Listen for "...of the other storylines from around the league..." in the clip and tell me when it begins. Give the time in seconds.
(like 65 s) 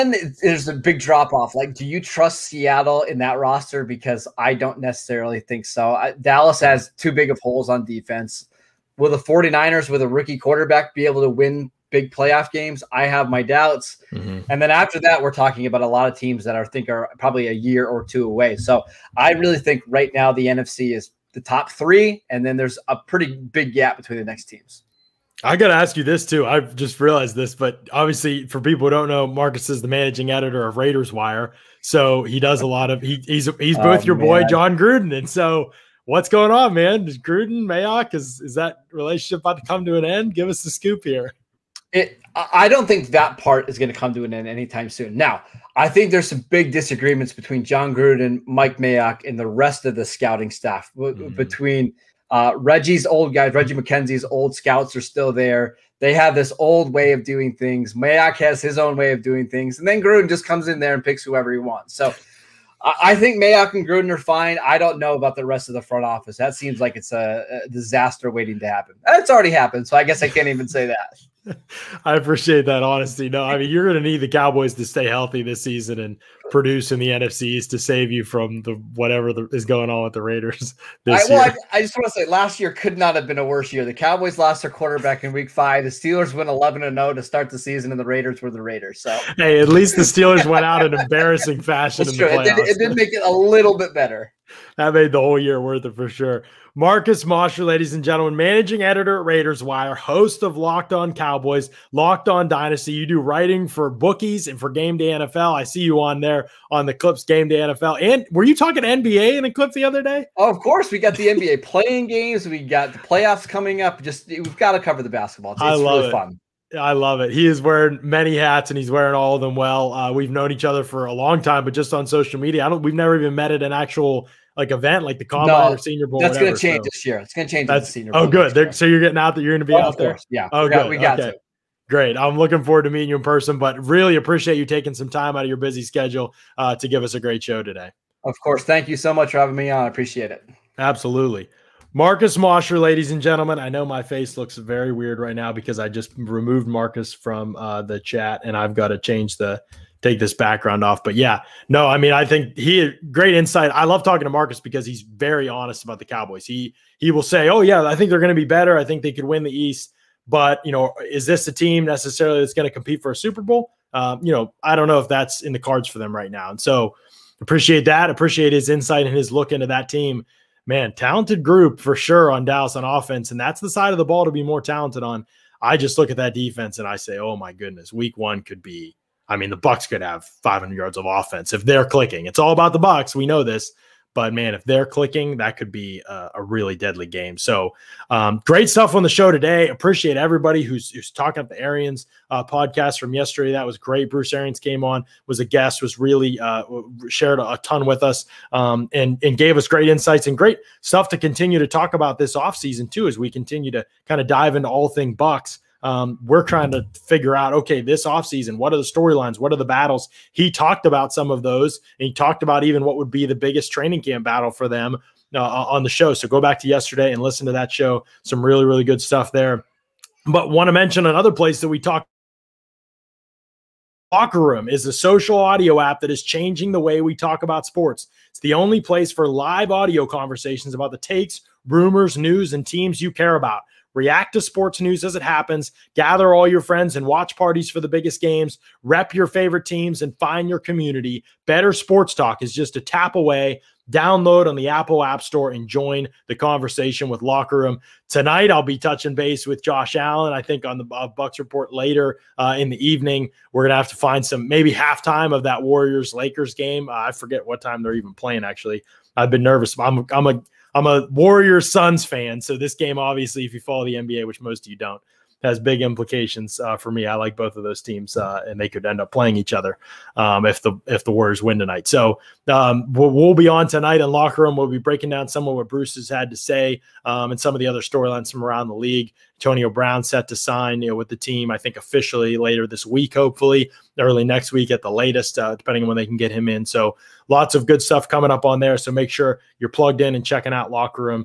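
277 s.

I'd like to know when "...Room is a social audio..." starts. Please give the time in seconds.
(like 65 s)
224 s.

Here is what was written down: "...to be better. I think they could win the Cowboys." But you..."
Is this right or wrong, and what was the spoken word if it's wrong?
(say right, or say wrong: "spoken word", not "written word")
wrong: "East", not "Cowboys".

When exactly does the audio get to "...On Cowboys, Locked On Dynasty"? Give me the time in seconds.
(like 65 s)
100 s.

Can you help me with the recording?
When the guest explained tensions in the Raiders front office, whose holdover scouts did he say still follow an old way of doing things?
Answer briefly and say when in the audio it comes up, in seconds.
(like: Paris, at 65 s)
Reggie McKenzie, at 53 s.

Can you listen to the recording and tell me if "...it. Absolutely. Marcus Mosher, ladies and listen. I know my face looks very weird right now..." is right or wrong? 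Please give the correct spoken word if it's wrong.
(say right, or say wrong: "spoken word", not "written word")
wrong: "gentlemen", not "listen".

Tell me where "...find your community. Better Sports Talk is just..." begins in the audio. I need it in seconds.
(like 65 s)
240 s.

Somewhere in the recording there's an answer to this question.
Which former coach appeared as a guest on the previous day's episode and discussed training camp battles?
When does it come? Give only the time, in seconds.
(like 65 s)
194 s.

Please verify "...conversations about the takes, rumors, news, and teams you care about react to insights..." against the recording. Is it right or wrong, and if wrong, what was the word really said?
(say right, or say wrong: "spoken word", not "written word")
wrong: "sports", not "insights".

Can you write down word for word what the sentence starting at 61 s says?
So I, think Mayock and Gruden are fine.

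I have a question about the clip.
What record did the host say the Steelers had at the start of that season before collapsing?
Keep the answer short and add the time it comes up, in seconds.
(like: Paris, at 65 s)
11-0, at 86 s.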